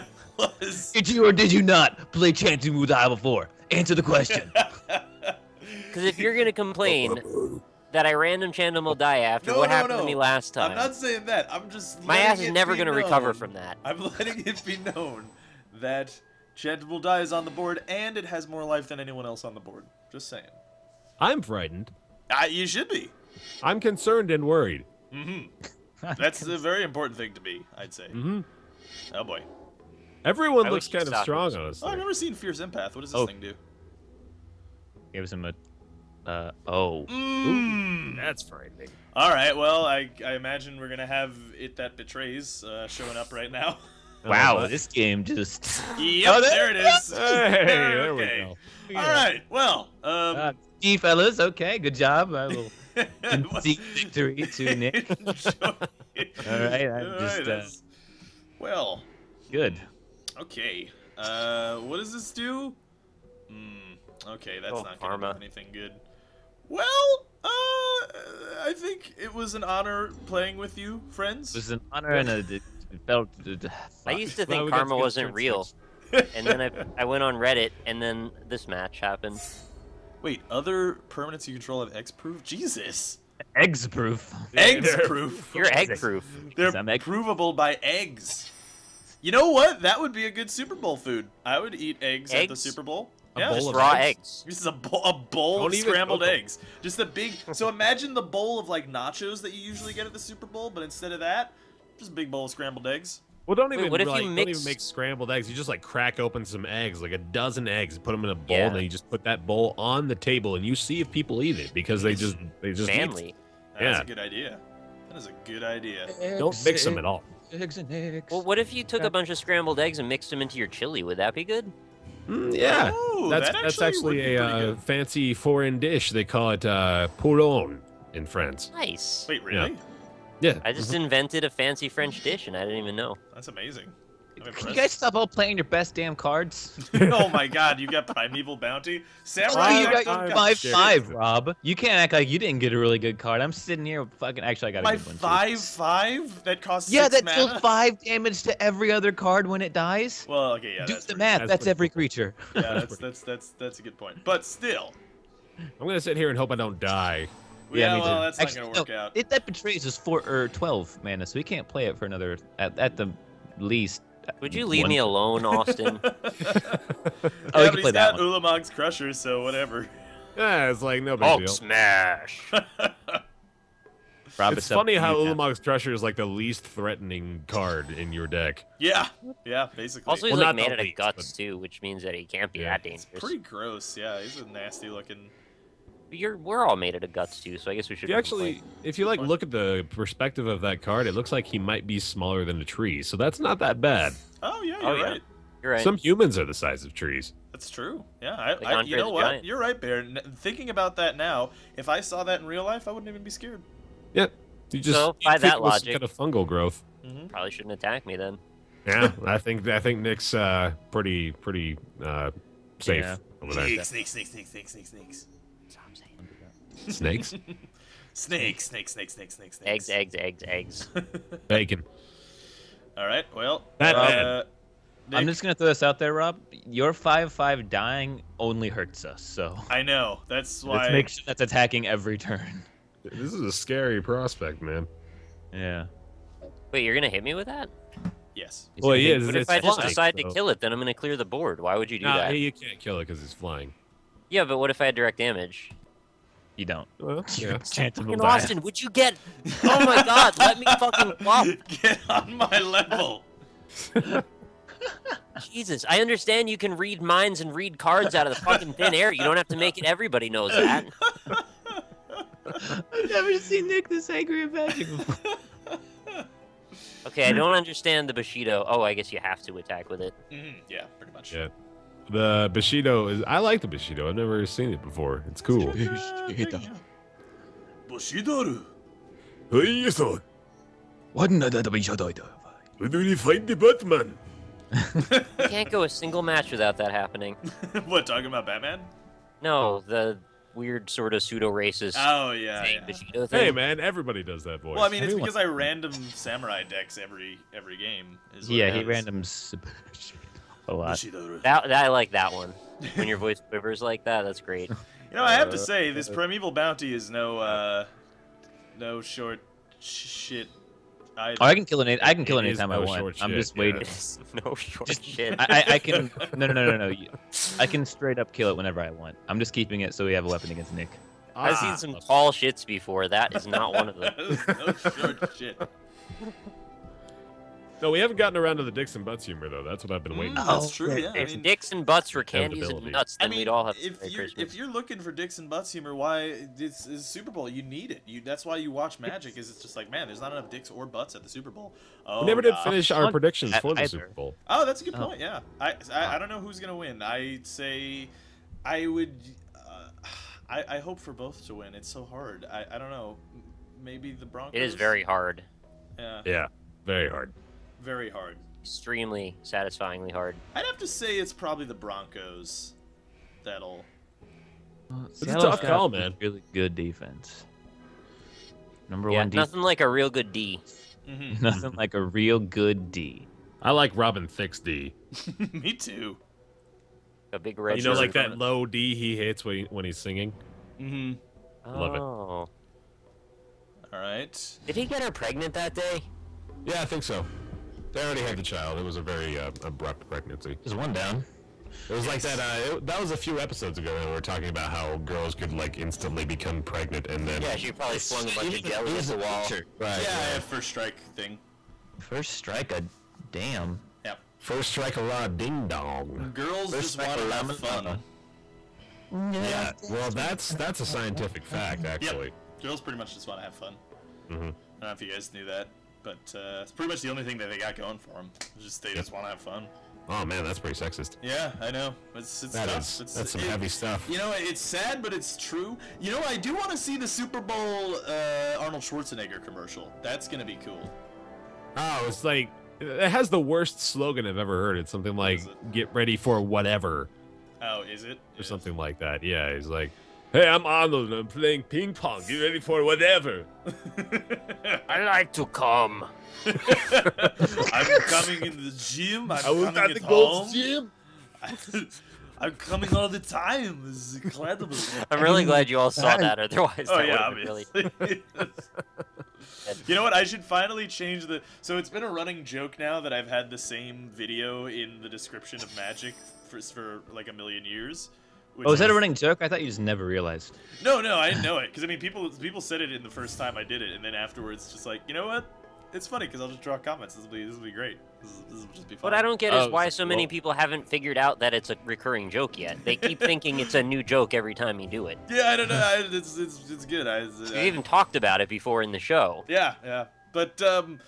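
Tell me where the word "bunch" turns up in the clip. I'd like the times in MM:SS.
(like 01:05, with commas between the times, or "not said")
01:59, 06:38.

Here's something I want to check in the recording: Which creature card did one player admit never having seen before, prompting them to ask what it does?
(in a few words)
Fierce Empath.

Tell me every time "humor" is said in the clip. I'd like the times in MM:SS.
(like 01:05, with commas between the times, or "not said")
05:29, 05:35.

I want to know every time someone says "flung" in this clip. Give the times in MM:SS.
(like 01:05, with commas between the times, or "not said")
06:37.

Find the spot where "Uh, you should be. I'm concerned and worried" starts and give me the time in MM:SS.
00:22.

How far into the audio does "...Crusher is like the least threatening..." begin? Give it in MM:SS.
02:55.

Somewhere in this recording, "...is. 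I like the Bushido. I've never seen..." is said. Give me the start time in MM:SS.
04:33.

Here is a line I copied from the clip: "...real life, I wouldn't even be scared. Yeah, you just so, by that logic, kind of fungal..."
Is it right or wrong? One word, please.
right.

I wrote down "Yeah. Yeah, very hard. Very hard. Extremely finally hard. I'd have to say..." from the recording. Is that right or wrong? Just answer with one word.
wrong.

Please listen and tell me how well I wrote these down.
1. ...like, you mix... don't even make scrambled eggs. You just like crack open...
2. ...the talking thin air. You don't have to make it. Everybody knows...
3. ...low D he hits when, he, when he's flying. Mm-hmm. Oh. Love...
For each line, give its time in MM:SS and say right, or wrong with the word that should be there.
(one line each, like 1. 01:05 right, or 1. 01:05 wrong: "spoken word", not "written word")
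1. 01:44 right
2. 04:18 wrong: "fucking", not "talking"
3. 06:18 wrong: "singing", not "flying".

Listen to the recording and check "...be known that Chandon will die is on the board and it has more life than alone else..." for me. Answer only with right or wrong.
wrong.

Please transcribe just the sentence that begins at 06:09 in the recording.
Yeah, Nothing like a real good D.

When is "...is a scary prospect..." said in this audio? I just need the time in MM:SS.
03:53.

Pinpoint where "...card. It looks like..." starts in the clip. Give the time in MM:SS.
03:10.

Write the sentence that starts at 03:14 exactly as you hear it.
Oh yeah, oh, you're oh, right.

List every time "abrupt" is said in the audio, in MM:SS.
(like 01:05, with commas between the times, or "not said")
06:29.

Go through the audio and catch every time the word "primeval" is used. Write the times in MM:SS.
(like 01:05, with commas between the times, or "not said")
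02:18, 05:06.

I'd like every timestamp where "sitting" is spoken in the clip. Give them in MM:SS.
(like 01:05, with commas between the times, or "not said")
02:23.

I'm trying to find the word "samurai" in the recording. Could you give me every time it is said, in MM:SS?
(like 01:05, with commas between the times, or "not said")
02:19, 04:55.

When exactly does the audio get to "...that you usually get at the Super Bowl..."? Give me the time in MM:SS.
01:39.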